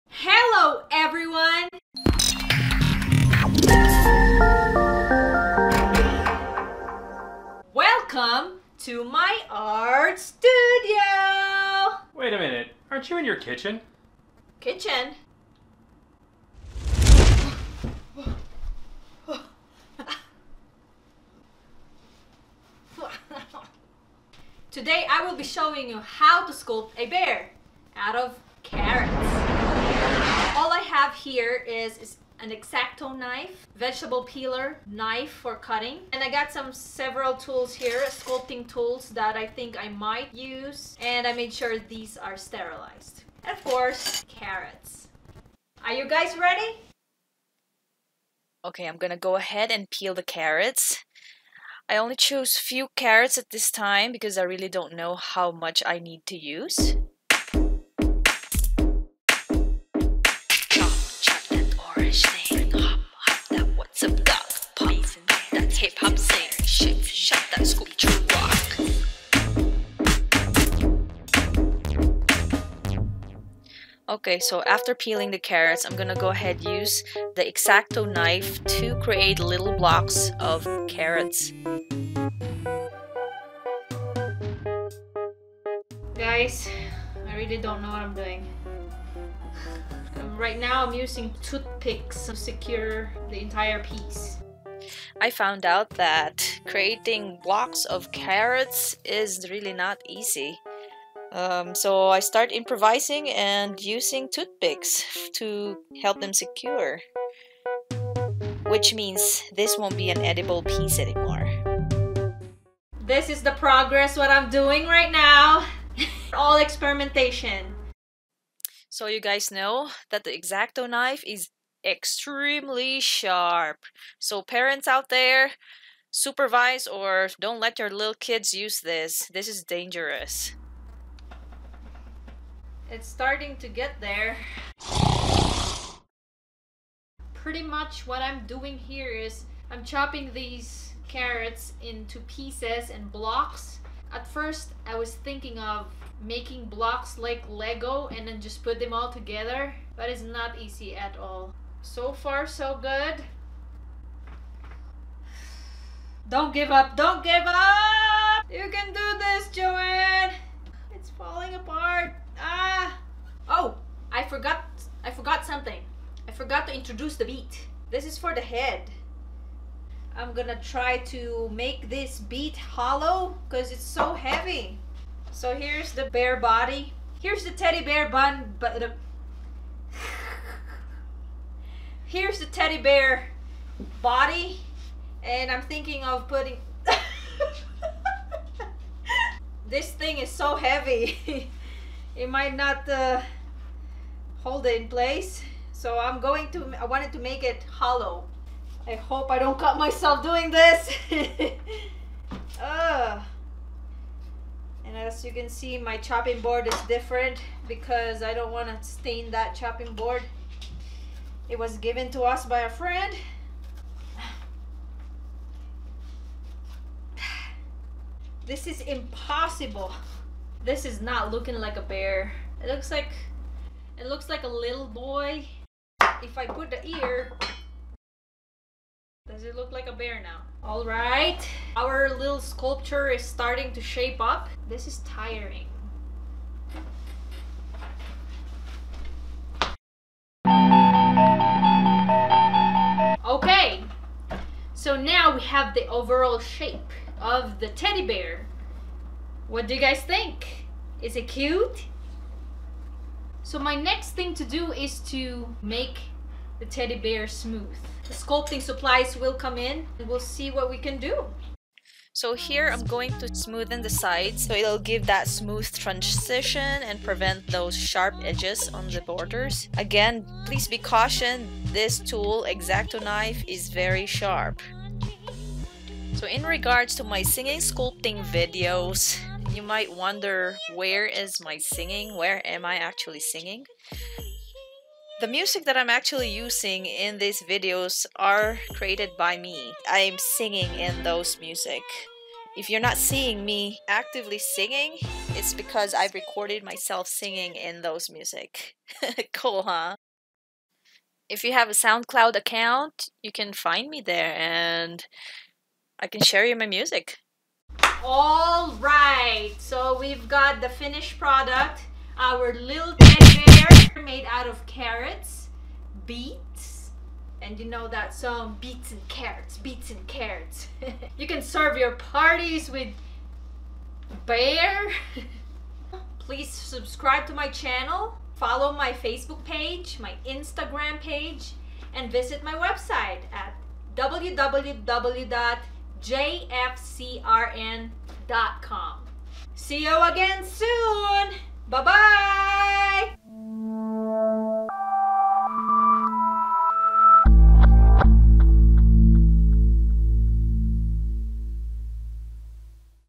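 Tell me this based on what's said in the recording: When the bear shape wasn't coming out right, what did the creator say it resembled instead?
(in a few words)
a little boy.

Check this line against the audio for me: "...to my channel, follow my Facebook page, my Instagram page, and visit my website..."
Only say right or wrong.
right.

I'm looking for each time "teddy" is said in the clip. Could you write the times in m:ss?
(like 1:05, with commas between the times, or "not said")
2:57, 3:02, 4:07, 4:16, 5:12.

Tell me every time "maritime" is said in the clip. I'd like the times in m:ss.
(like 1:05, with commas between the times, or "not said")
not said.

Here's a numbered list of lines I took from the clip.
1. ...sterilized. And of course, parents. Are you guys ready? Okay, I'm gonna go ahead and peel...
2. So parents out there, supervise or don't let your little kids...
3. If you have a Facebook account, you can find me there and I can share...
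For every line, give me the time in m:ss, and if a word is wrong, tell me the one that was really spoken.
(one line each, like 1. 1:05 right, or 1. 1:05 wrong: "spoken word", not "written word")
1. 0:42 wrong: "carrots", not "parents"
2. 2:04 right
3. 5:01 wrong: "SoundCloud", not "Facebook".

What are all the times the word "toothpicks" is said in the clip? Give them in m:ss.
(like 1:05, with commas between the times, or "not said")
1:31, 1:44.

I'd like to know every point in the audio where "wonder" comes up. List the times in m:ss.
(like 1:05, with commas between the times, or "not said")
4:39.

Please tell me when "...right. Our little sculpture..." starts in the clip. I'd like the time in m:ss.
3:50.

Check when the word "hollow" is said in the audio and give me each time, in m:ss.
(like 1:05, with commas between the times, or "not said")
2:52, 3:17.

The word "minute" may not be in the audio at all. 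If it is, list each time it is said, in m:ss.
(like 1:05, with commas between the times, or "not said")
0:12.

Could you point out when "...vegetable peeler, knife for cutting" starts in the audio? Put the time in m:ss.
0:33.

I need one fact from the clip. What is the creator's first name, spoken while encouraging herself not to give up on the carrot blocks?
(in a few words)
Joanne.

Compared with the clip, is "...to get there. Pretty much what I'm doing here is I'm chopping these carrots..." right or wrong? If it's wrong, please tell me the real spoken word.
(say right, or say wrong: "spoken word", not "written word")
right.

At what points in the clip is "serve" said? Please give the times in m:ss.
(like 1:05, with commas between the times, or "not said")
5:21.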